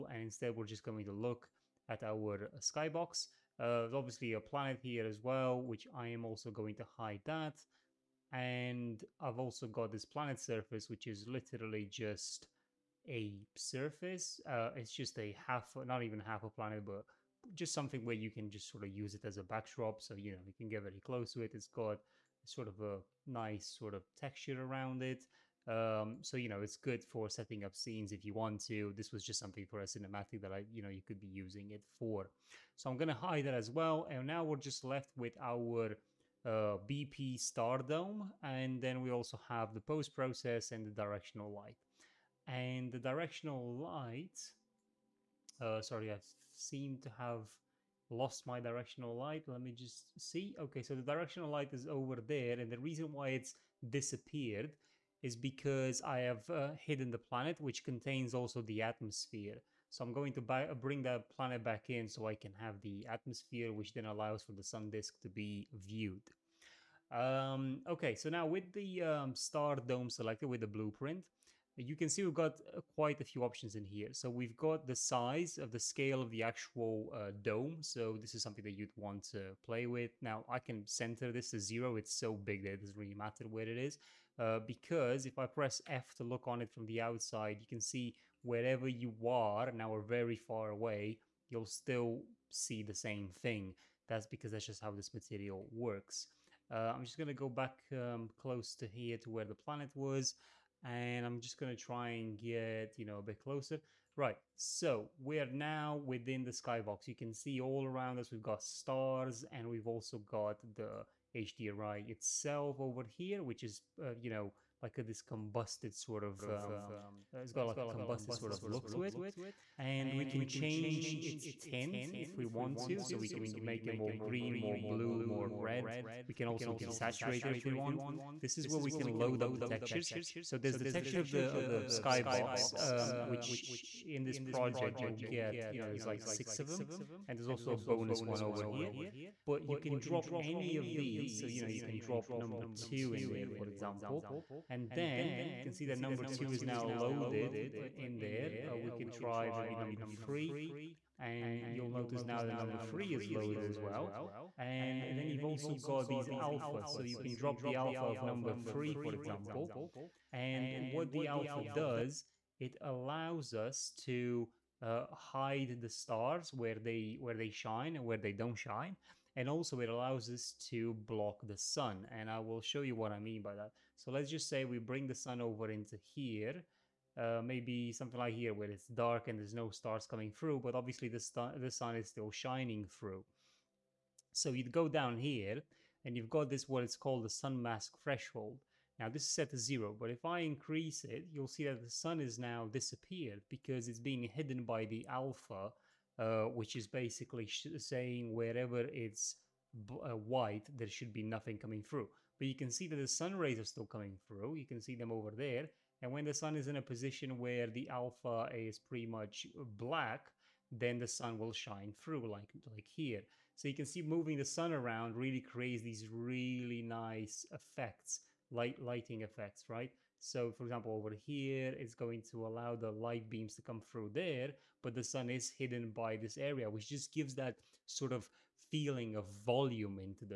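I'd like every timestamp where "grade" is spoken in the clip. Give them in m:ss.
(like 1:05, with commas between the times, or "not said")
not said.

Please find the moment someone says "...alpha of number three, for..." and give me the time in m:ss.
2:37.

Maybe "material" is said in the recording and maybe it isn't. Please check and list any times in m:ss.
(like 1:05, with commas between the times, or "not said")
1:35.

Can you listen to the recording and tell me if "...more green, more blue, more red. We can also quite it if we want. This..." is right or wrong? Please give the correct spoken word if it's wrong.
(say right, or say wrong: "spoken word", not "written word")
wrong: "desaturate", not "quite".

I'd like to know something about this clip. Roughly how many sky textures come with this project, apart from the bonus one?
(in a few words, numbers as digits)
6.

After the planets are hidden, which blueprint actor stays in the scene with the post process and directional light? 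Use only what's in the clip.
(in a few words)
BP Stardome.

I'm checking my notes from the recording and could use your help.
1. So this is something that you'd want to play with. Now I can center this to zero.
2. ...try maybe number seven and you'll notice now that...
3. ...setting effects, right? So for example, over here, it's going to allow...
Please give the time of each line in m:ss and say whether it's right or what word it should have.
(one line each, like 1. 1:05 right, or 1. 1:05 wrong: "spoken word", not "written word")
1. 1:17 right
2. 2:29 wrong: "three", not "seven"
3. 3:38 wrong: "lighting", not "setting".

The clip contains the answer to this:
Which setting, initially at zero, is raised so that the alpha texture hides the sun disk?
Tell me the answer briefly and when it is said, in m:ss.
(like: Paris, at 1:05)
sun mask threshold, at 3:07.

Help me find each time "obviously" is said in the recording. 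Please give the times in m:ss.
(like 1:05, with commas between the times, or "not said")
0:03, 3:00.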